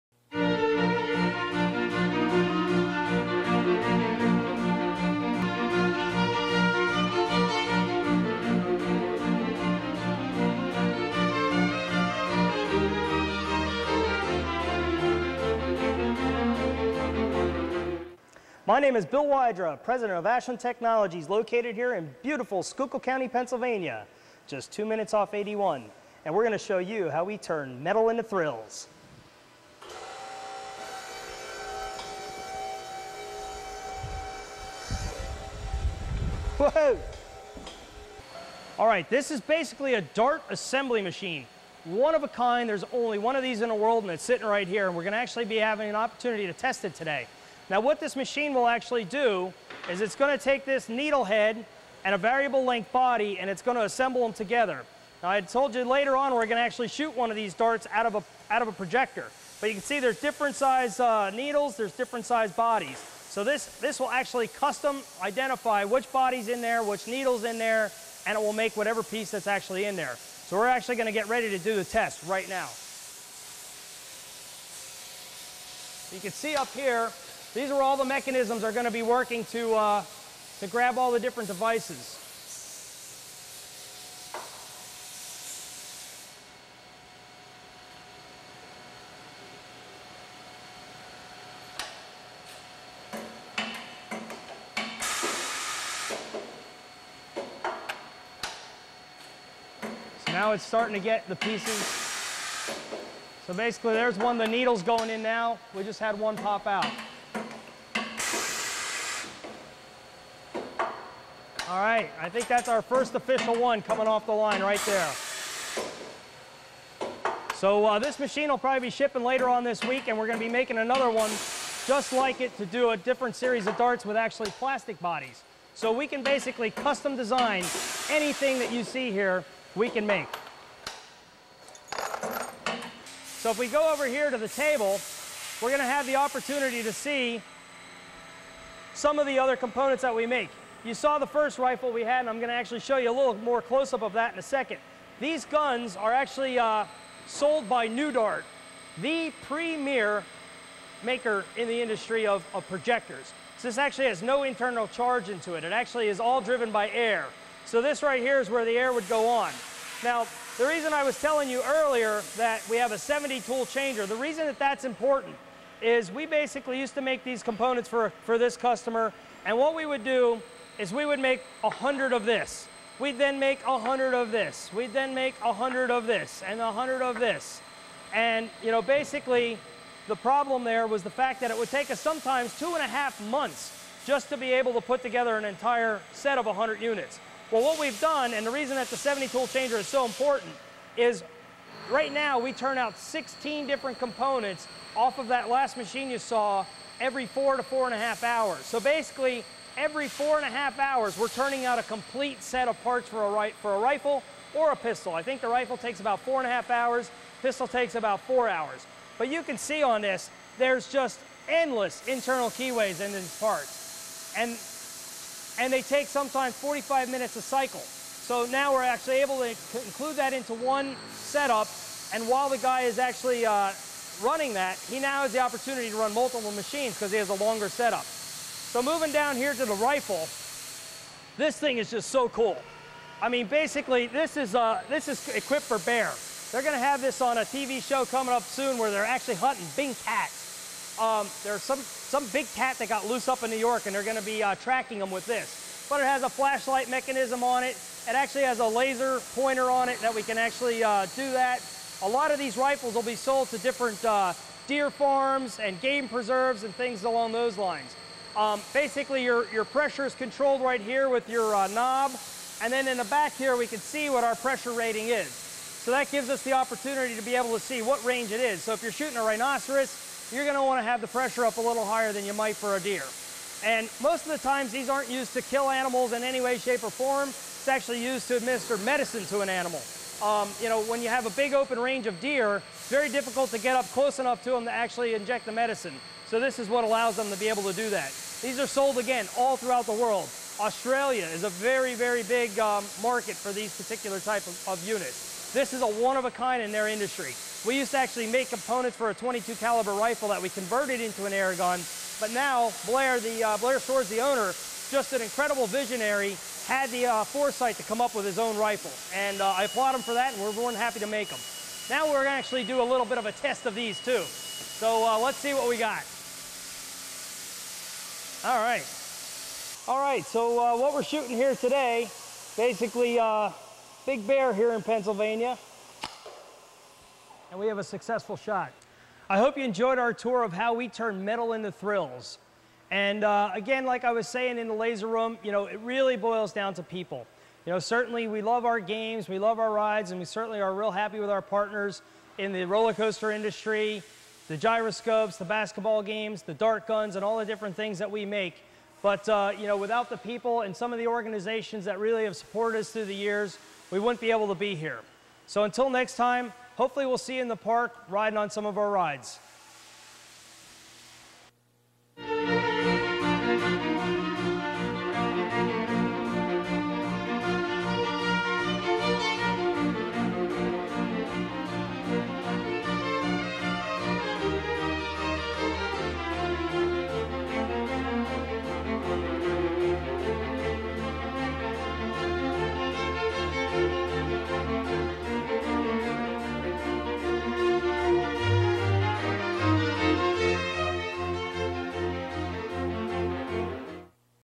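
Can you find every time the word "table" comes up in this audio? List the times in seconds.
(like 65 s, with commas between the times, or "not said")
134 s.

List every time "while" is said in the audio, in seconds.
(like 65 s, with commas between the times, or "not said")
222 s.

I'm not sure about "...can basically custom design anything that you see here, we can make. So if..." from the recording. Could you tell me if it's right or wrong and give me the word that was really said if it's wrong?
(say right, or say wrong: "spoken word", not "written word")
right.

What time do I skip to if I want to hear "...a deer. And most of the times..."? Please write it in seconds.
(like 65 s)
272 s.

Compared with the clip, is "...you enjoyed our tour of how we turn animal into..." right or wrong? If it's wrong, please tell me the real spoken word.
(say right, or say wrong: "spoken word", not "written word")
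wrong: "metal", not "animal".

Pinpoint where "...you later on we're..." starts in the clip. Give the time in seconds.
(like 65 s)
55 s.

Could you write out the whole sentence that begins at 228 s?
So moving down here to the rifle, this thing is just so cool.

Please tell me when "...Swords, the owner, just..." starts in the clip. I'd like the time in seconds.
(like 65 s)
303 s.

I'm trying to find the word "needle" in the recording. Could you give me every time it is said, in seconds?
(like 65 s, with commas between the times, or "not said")
50 s, 61 s, 67 s, 104 s.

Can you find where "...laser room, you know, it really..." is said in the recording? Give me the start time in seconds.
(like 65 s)
334 s.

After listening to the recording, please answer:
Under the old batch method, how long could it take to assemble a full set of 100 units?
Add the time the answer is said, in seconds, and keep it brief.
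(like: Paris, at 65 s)
two and a half months, at 182 s.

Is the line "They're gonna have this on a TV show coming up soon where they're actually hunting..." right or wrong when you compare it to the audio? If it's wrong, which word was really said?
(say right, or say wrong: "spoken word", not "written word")
right.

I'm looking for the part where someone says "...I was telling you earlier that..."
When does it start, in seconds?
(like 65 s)
160 s.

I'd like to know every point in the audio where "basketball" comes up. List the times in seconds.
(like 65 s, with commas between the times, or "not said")
345 s.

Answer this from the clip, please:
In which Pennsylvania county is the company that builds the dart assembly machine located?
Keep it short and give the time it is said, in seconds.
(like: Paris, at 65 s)
Schuylkill County, at 22 s.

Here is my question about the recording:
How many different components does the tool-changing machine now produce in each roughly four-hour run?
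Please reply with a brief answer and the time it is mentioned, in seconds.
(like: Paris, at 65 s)
16, at 192 s.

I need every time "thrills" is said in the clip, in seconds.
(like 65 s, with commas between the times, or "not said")
28 s, 331 s.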